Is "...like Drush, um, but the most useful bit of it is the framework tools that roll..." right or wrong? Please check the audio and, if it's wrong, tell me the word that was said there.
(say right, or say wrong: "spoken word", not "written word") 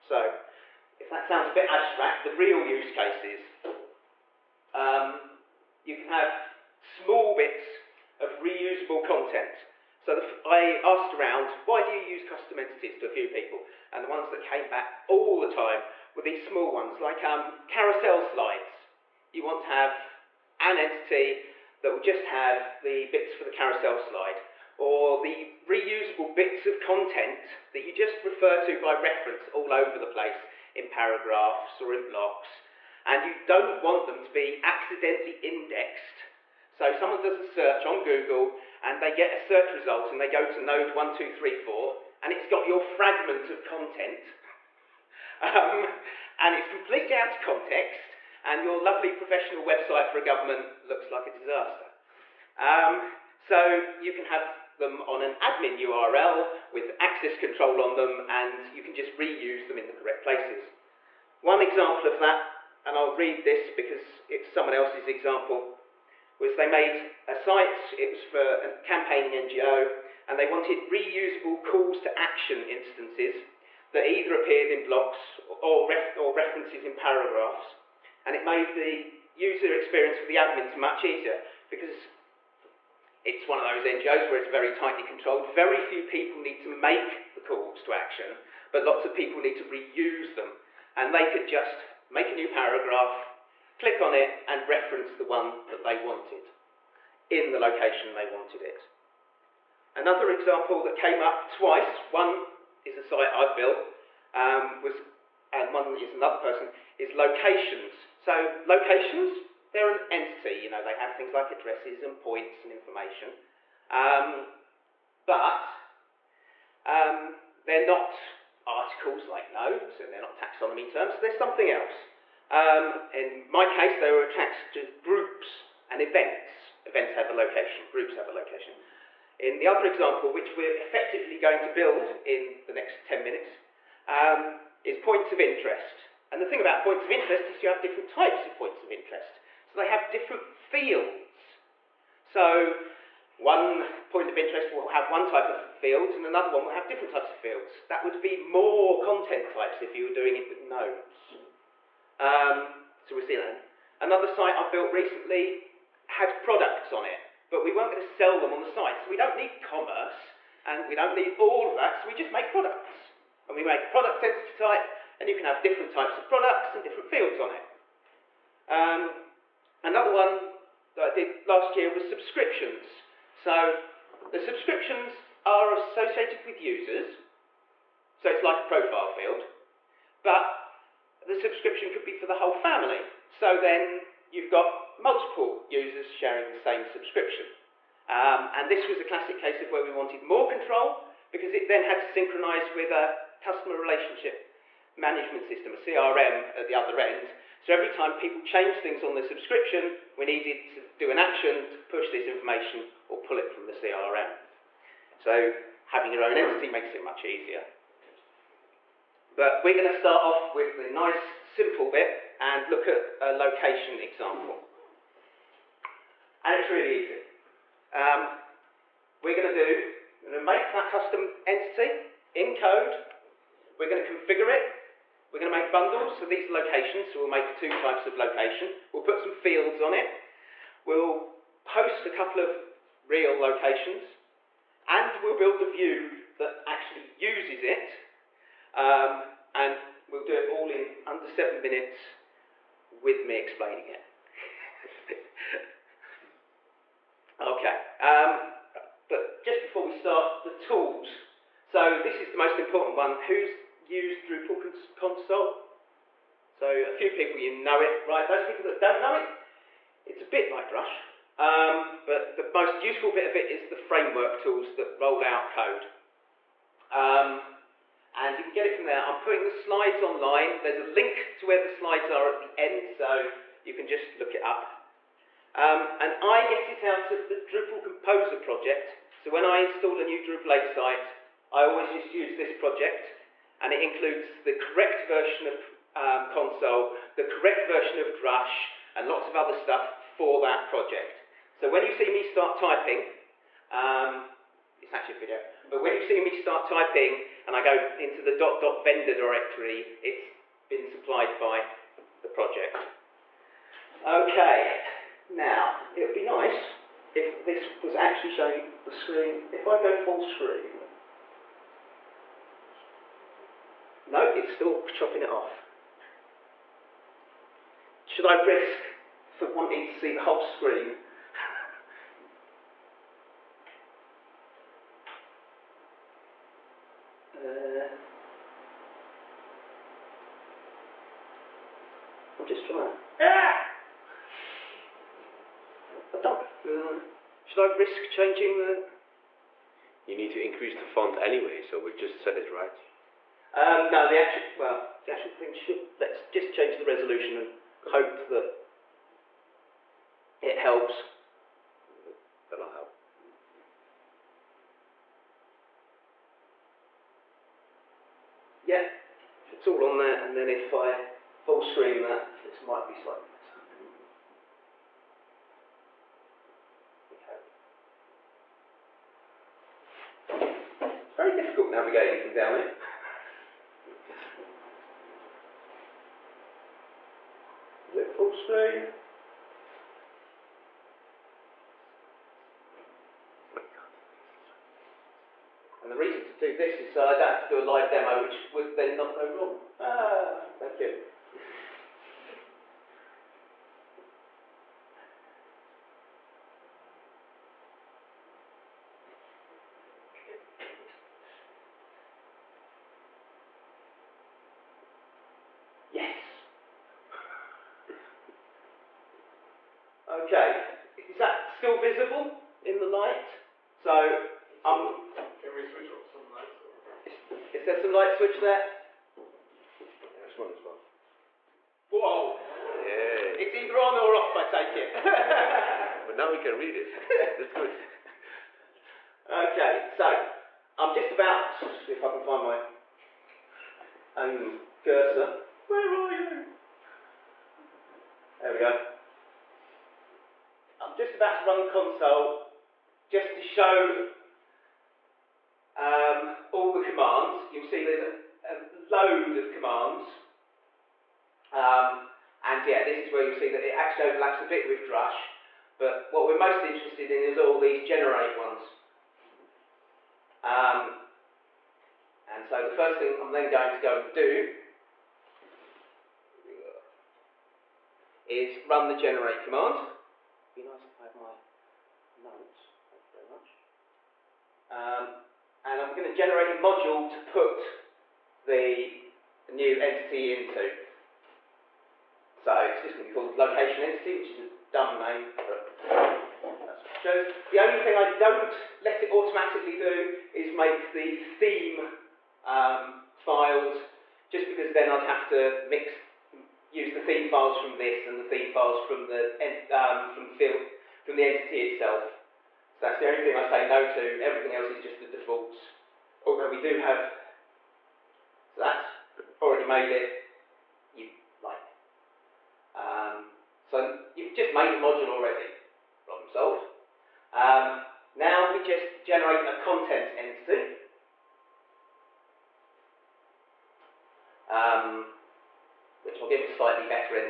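right.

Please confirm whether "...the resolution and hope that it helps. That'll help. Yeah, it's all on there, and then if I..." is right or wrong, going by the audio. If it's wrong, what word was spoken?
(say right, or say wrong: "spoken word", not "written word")
right.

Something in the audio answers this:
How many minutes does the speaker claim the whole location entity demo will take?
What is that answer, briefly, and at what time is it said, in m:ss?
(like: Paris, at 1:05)
7, at 4:01.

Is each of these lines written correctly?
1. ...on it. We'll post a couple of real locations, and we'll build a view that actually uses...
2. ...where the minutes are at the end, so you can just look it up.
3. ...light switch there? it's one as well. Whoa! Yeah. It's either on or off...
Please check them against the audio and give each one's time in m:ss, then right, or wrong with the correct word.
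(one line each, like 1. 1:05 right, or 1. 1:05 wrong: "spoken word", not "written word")
1. 3:49 right
2. 4:31 wrong: "slides", not "minutes"
3. 6:57 right.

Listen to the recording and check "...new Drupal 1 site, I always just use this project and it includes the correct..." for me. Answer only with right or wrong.
wrong.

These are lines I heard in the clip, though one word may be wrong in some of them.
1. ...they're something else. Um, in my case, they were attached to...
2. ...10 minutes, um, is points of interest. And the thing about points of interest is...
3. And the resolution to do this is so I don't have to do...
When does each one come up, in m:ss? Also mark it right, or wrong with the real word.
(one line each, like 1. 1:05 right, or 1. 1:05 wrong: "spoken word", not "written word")
1. 2:01 right
2. 2:13 right
3. 6:25 wrong: "reason", not "resolution".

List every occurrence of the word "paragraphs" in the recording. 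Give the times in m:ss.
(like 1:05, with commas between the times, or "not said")
0:30, 1:16, 1:32.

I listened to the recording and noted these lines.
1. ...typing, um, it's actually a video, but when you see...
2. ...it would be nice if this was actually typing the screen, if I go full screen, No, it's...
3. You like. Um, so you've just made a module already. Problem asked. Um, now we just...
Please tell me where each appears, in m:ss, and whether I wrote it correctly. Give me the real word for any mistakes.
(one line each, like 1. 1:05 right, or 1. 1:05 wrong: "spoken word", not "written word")
1. 4:52 right
2. 5:05 wrong: "showing", not "typing"
3. 8:30 wrong: "solved", not "asked".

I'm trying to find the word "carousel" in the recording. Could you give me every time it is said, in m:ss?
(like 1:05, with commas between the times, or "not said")
0:17, 0:23.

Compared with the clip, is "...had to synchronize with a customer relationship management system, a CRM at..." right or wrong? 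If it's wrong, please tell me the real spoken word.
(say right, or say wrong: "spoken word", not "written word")
right.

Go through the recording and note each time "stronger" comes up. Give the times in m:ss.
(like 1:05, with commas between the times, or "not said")
not said.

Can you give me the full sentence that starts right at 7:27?
You'll see there's a, a load of commands.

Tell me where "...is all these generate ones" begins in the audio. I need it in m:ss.
7:37.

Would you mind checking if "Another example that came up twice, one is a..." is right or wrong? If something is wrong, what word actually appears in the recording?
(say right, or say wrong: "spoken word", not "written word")
right.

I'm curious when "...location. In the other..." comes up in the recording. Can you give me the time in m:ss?
2:08.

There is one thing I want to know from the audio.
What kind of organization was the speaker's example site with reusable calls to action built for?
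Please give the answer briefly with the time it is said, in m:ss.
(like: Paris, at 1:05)
campaigning NGO, at 1:08.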